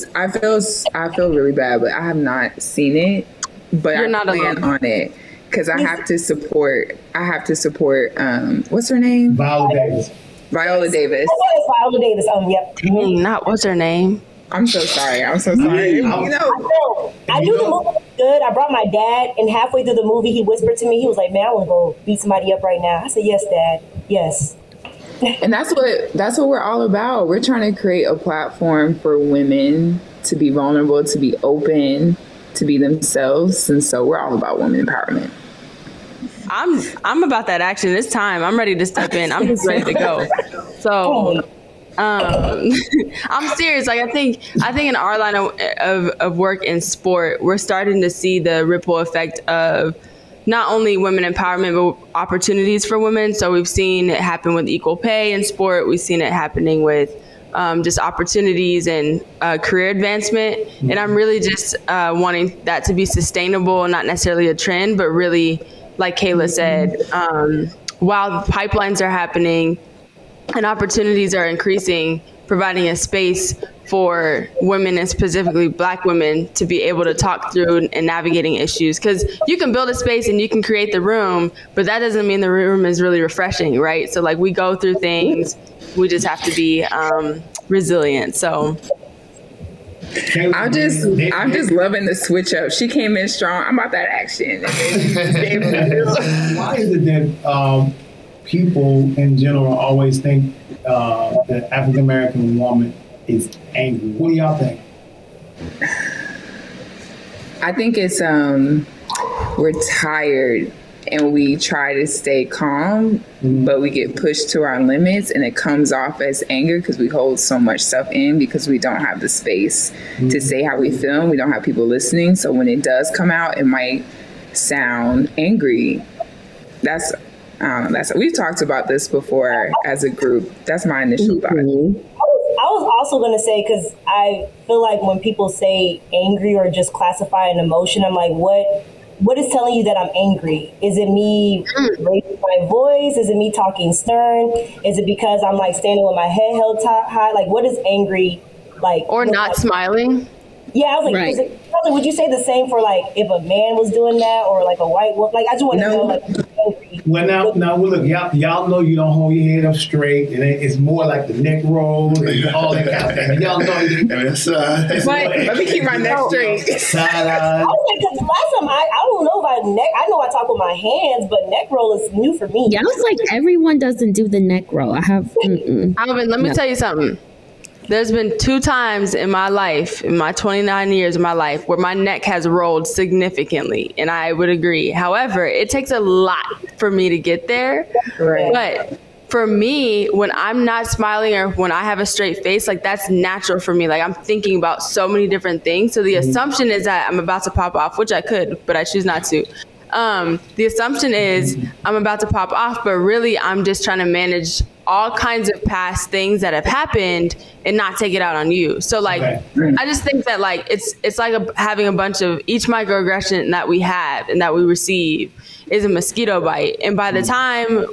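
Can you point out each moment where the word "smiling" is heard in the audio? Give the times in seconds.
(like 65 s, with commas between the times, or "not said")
149 s, 190 s.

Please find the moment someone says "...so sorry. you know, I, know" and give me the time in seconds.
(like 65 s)
15 s.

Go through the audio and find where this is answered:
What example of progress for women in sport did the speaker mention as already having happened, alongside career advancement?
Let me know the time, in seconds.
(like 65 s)
54 s.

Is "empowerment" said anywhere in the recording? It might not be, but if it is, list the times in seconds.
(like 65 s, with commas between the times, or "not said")
34 s, 51 s.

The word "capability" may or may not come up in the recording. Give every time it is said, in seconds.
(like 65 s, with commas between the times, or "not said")
not said.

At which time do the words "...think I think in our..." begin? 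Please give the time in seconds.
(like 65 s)
44 s.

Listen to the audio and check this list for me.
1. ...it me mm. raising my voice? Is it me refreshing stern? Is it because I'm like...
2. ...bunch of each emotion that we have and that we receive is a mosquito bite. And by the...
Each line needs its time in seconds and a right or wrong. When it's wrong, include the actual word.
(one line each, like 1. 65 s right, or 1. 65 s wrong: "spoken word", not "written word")
1. 140 s wrong: "talking", not "refreshing"
2. 211 s wrong: "microaggression", not "emotion".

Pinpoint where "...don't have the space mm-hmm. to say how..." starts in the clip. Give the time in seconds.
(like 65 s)
118 s.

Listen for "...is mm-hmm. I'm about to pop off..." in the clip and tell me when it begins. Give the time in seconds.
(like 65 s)
201 s.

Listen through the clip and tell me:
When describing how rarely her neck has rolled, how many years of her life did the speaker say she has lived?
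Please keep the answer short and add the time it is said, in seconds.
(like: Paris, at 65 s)
29, at 180 s.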